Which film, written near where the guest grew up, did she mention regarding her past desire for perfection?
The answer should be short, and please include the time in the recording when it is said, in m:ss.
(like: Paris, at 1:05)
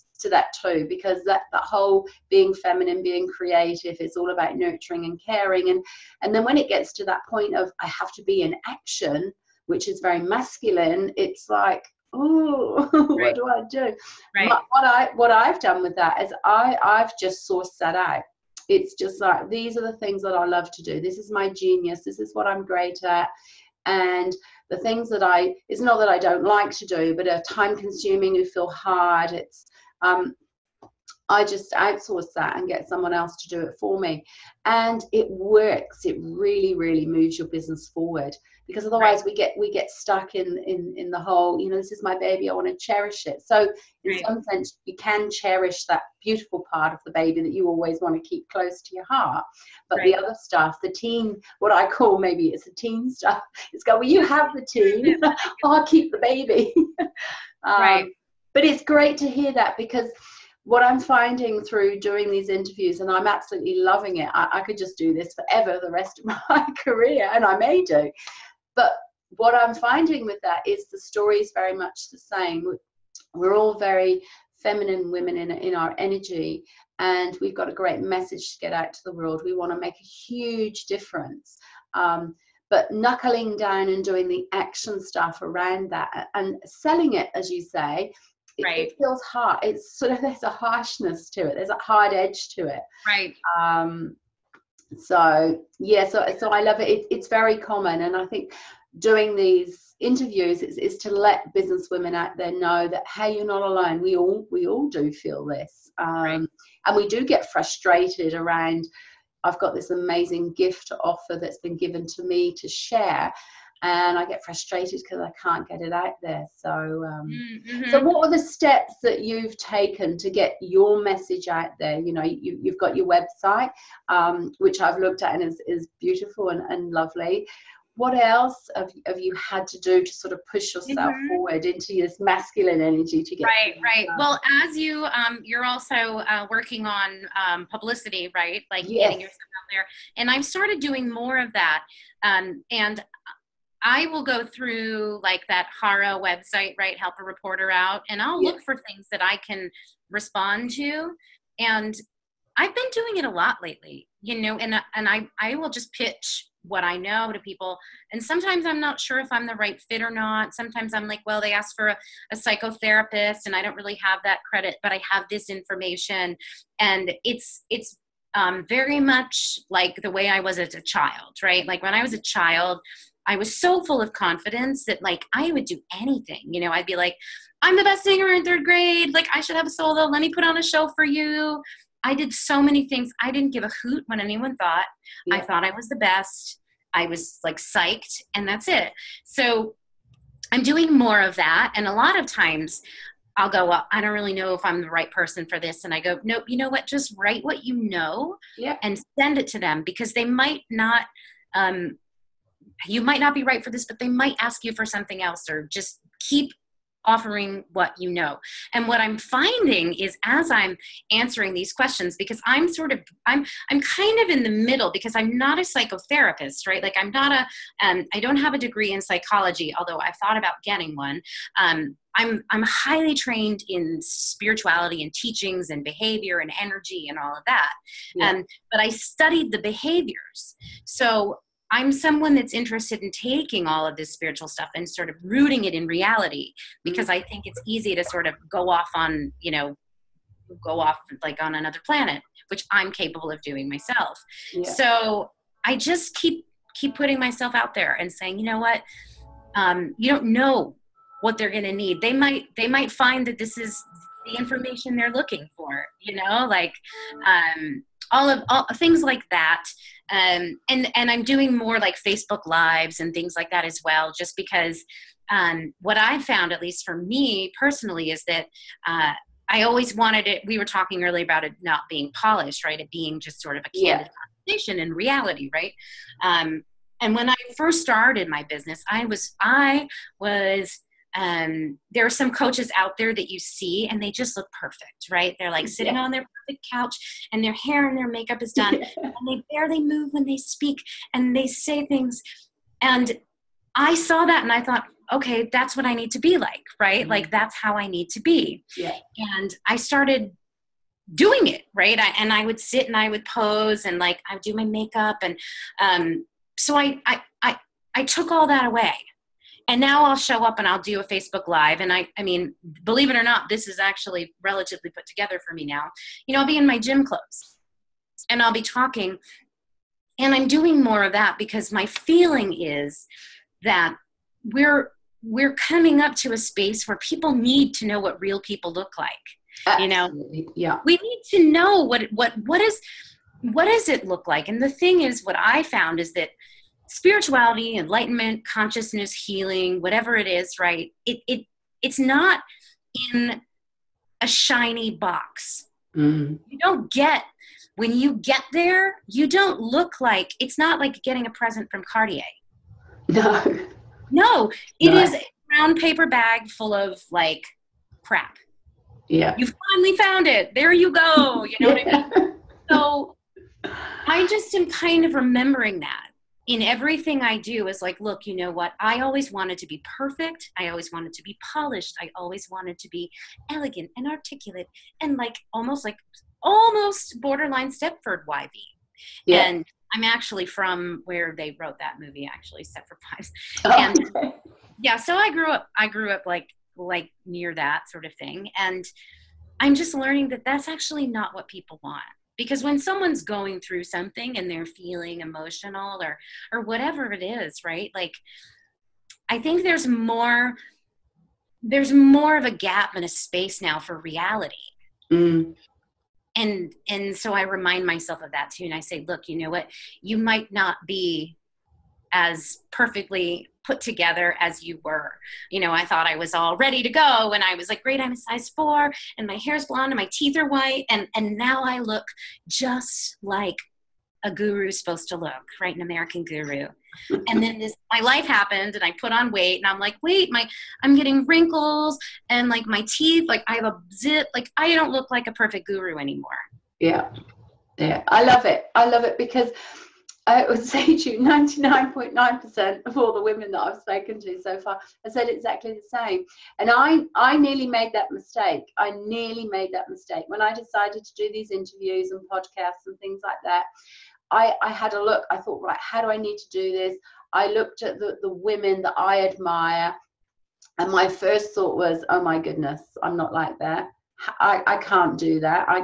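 Stepford Wives, at 6:22.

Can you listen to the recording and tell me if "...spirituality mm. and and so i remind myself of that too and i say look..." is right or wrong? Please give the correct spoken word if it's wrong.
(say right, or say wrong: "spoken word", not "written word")
wrong: "reality", not "spirituality".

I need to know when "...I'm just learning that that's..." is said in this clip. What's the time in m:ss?
6:29.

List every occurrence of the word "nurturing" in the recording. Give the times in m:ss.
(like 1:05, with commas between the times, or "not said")
0:04.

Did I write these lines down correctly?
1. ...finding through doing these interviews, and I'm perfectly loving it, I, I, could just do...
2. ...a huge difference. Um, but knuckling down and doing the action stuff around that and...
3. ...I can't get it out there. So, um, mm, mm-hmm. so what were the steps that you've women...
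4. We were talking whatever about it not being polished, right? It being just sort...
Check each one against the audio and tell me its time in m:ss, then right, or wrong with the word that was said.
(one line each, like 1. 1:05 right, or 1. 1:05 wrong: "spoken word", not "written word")
1. 1:00 wrong: "absolutely", not "perfectly"
2. 1:19 right
3. 1:55 wrong: "taken", not "women"
4. 4:30 wrong: "earlier", not "whatever".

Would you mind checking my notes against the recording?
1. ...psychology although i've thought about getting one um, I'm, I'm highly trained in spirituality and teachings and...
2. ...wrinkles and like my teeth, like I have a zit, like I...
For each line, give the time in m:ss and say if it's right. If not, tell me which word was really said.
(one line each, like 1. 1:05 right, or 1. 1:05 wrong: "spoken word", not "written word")
1. 3:39 right
2. 7:11 right.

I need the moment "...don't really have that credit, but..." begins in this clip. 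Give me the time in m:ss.
2:43.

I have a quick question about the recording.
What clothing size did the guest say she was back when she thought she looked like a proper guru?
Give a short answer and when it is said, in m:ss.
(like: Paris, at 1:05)
4, at 6:58.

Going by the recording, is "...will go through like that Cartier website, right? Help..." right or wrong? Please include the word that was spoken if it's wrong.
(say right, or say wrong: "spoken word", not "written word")
wrong: "HARO", not "Cartier".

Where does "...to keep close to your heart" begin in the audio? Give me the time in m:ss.
0:48.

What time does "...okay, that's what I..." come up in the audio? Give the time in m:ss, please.
4:55.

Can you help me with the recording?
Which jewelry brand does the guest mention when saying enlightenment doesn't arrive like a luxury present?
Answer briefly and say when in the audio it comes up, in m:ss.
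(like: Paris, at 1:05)
Cartier, at 5:51.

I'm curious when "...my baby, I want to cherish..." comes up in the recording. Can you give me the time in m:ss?
0:42.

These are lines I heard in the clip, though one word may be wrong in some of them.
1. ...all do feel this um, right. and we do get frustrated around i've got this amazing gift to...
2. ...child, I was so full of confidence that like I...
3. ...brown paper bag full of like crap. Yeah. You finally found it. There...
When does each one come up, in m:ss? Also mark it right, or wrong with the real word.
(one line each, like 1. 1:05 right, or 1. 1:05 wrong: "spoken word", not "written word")
1. 1:44 right
2. 2:52 right
3. 5:55 right.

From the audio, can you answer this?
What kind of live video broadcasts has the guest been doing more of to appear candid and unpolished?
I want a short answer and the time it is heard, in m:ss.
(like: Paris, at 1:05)
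Facebook Lives, at 4:22.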